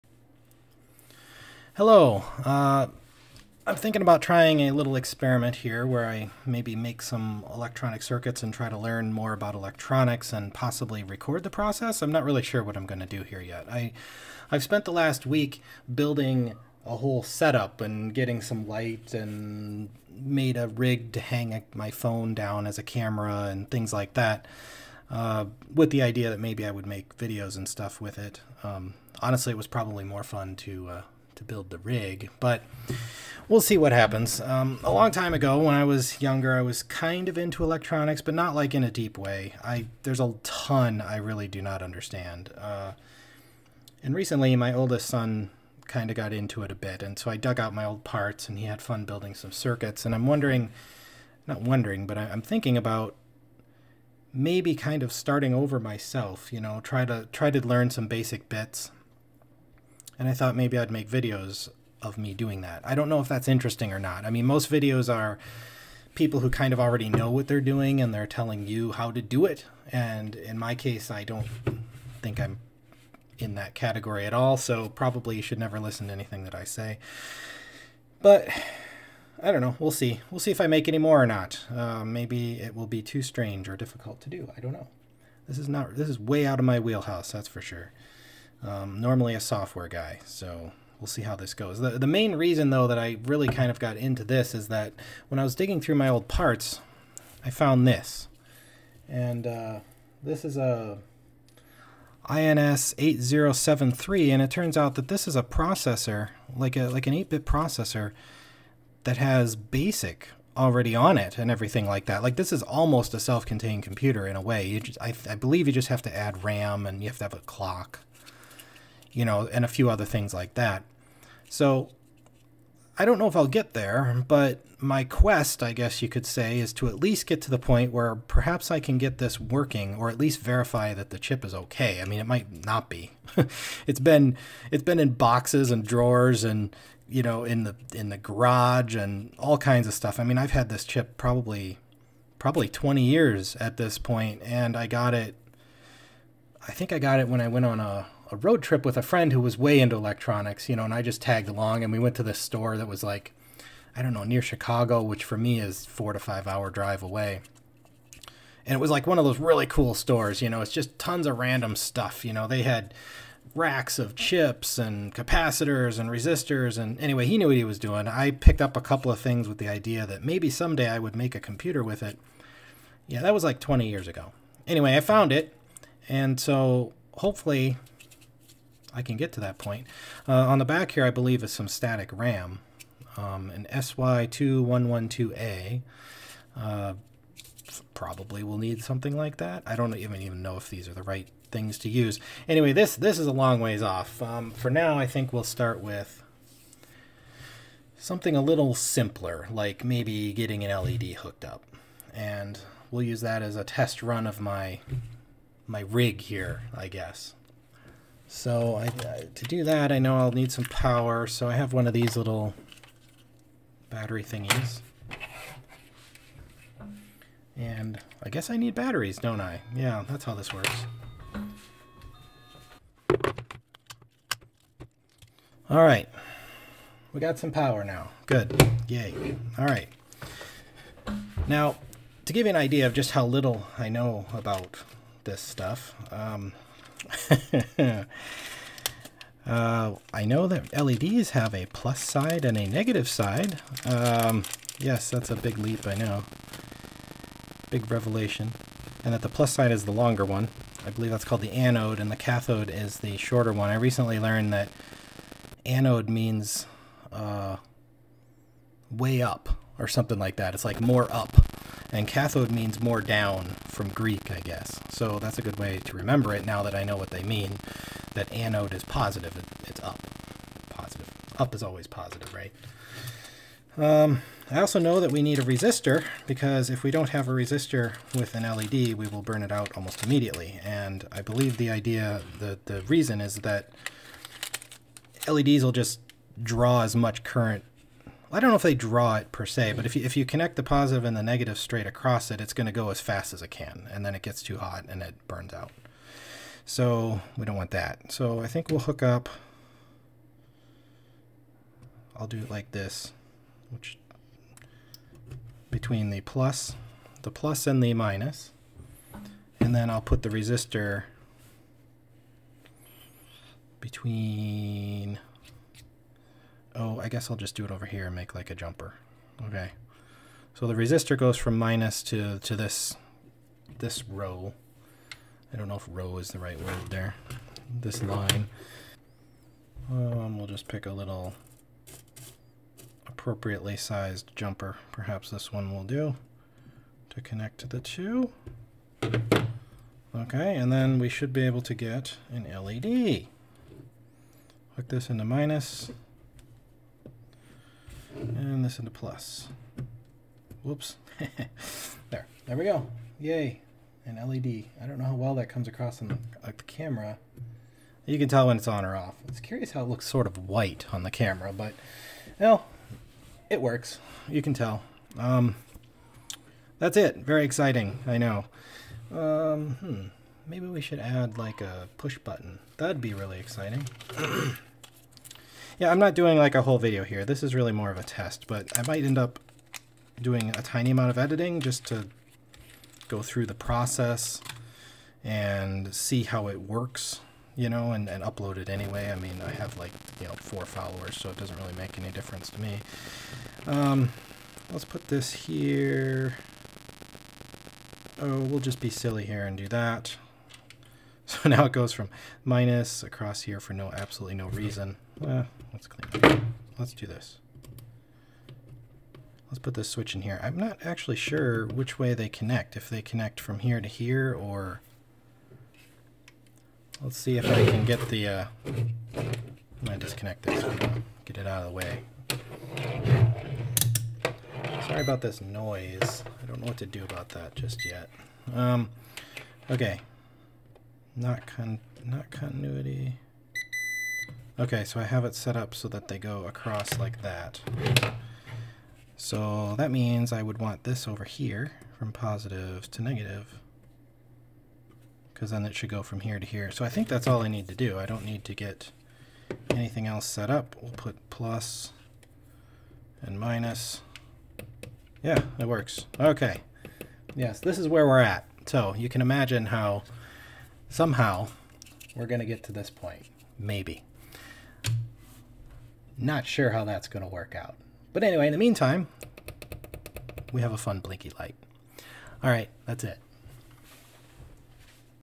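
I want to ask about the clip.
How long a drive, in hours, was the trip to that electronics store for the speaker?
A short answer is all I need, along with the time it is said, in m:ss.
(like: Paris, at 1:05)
4 to 5 hours, at 2:35.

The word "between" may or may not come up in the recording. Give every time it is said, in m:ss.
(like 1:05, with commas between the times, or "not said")
5:05, 5:13.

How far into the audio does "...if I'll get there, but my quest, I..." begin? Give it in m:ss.
2:03.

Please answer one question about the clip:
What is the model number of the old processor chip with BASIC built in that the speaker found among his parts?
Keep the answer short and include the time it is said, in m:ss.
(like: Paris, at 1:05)
INS 8073, at 1:42.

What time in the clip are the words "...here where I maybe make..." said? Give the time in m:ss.
0:05.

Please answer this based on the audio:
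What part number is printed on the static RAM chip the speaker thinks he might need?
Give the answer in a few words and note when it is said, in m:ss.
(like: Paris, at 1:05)
SY2112A, at 3:03.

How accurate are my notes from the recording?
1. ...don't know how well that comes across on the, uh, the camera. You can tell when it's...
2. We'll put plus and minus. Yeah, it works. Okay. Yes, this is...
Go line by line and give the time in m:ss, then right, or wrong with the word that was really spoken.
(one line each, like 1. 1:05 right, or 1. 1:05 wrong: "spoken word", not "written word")
1. 5:54 right
2. 7:30 right.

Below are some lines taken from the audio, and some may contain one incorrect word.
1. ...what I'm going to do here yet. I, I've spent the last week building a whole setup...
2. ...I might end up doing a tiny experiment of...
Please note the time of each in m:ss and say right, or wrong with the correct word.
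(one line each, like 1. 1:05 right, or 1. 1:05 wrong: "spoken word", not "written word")
1. 0:12 right
2. 6:18 wrong: "amount", not "experiment".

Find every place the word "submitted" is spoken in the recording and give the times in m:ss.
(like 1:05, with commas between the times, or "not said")
not said.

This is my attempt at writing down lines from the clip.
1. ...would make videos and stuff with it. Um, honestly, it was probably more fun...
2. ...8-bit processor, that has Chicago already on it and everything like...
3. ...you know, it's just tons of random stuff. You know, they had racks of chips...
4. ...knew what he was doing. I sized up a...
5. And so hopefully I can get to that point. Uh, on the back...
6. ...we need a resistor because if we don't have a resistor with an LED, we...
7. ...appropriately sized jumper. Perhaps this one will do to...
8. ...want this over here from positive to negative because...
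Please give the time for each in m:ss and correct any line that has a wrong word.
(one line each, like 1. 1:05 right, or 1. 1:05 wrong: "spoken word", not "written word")
1. 0:26 right
2. 1:47 wrong: "BASIC", not "Chicago"
3. 2:40 right
4. 2:47 wrong: "picked", not "sized"
5. 2:56 right
6. 4:35 right
7. 5:33 right
8. 7:20 right.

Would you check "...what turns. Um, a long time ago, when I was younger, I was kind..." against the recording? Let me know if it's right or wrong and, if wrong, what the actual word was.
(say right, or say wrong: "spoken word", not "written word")
wrong: "happens", not "turns".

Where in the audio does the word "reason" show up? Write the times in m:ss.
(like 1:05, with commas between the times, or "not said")
1:32, 4:42, 6:44.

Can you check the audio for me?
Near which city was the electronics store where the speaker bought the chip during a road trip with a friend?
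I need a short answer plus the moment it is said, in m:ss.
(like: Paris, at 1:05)
Chicago, at 2:34.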